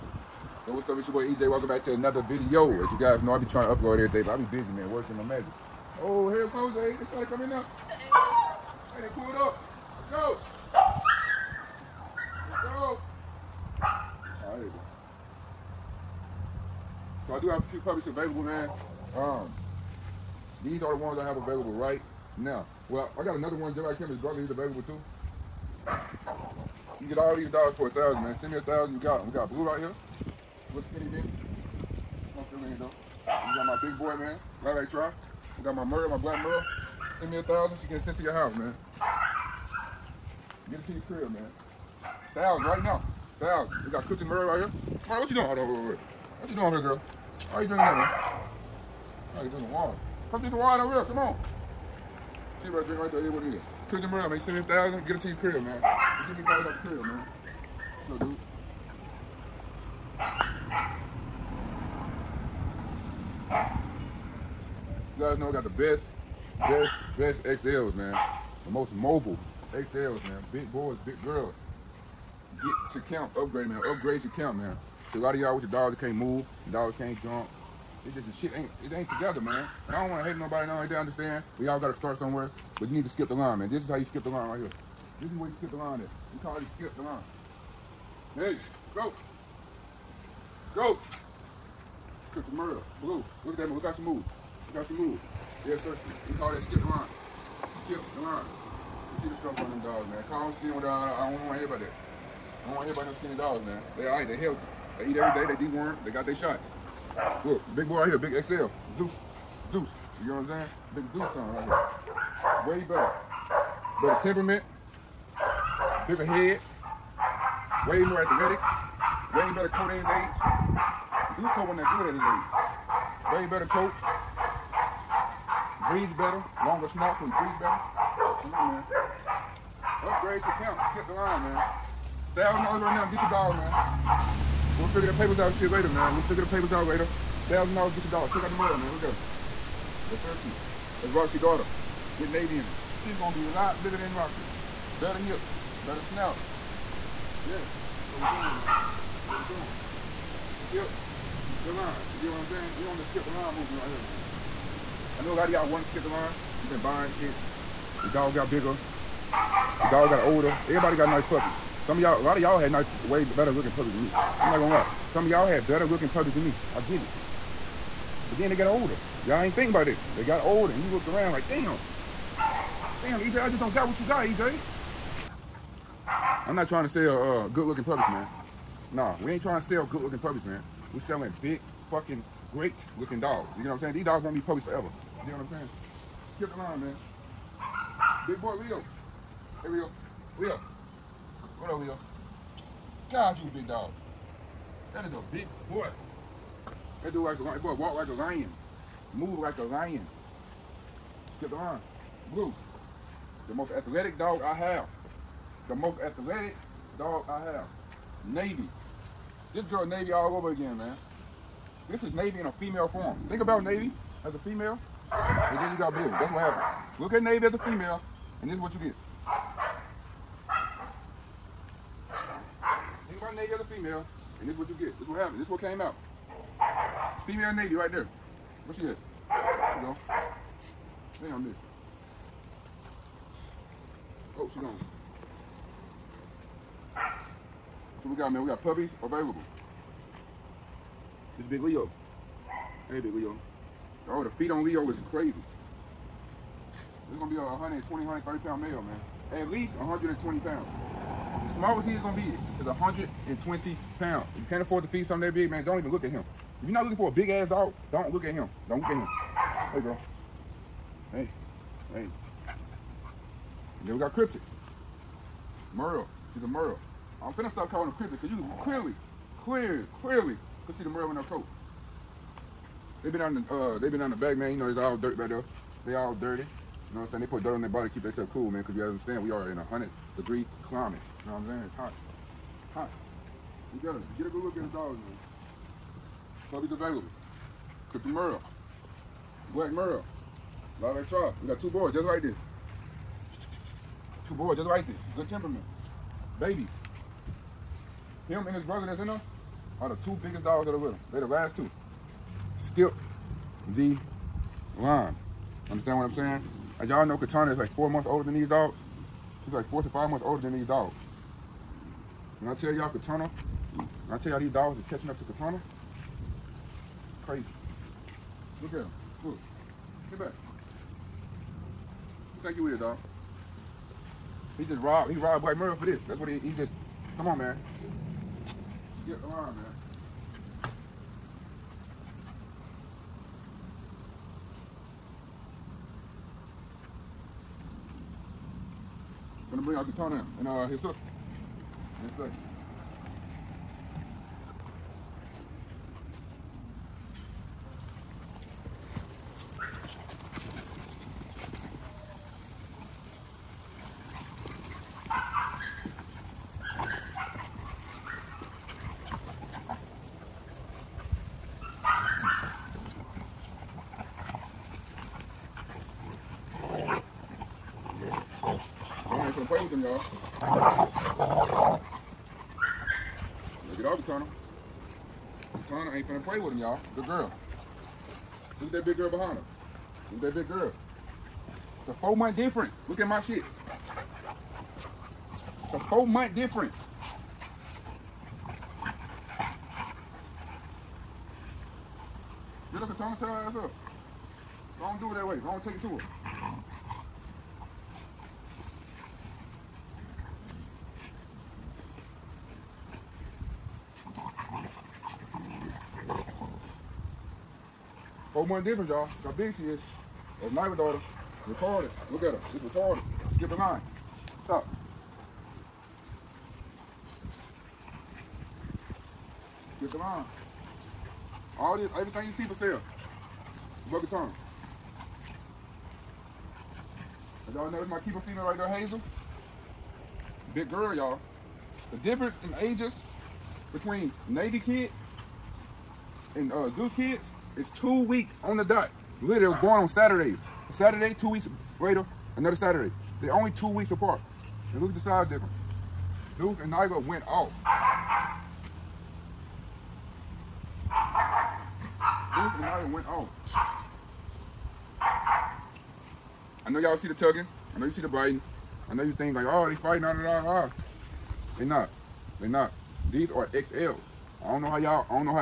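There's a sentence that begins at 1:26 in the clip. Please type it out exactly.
You can really skip the line.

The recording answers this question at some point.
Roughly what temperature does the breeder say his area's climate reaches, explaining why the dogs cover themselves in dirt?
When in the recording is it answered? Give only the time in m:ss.
4:39.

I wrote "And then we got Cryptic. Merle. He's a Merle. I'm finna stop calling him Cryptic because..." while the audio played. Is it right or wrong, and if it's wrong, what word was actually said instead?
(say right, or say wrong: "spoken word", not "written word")
right.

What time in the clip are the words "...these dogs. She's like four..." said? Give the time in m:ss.
5:08.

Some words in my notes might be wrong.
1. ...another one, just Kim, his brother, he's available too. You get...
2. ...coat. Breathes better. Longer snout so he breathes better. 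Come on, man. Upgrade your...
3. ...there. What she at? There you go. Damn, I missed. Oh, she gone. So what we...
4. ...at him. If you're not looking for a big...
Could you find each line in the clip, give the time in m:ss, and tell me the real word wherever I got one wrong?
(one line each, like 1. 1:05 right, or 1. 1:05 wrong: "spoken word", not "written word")
1. 0:23 right
2. 2:03 right
3. 3:47 right
4. 4:16 right.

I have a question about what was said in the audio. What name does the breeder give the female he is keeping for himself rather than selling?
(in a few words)
Hazel.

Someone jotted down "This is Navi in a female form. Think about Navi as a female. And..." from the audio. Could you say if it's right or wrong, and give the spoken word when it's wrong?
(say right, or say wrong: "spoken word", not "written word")
right.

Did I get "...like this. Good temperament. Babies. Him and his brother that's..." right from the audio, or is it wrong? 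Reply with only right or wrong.
right.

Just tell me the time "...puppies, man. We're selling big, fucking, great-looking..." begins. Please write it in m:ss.
3:00.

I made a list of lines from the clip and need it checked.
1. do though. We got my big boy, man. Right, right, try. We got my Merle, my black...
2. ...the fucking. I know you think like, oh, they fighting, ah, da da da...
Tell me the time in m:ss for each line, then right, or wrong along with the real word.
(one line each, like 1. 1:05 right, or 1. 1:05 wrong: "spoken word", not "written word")
1. 0:32 right
2. 7:38 wrong: "biting", not "fucking".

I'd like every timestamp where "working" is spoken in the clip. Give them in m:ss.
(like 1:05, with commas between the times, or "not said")
0:04.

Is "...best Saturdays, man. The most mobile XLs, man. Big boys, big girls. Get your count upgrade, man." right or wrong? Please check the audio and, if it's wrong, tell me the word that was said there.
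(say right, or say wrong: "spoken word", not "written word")
wrong: "XLs", not "Saturdays".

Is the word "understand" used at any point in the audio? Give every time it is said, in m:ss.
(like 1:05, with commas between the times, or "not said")
1:20, 4:38, 5:05.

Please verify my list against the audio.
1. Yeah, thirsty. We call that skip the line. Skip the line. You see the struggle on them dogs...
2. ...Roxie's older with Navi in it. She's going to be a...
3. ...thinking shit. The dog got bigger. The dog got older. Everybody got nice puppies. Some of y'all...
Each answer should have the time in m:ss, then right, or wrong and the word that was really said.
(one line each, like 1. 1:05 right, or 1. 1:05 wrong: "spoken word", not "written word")
1. 1:35 right
2. 2:21 wrong: "daughter", not "older"
3. 2:36 wrong: "buying", not "thinking".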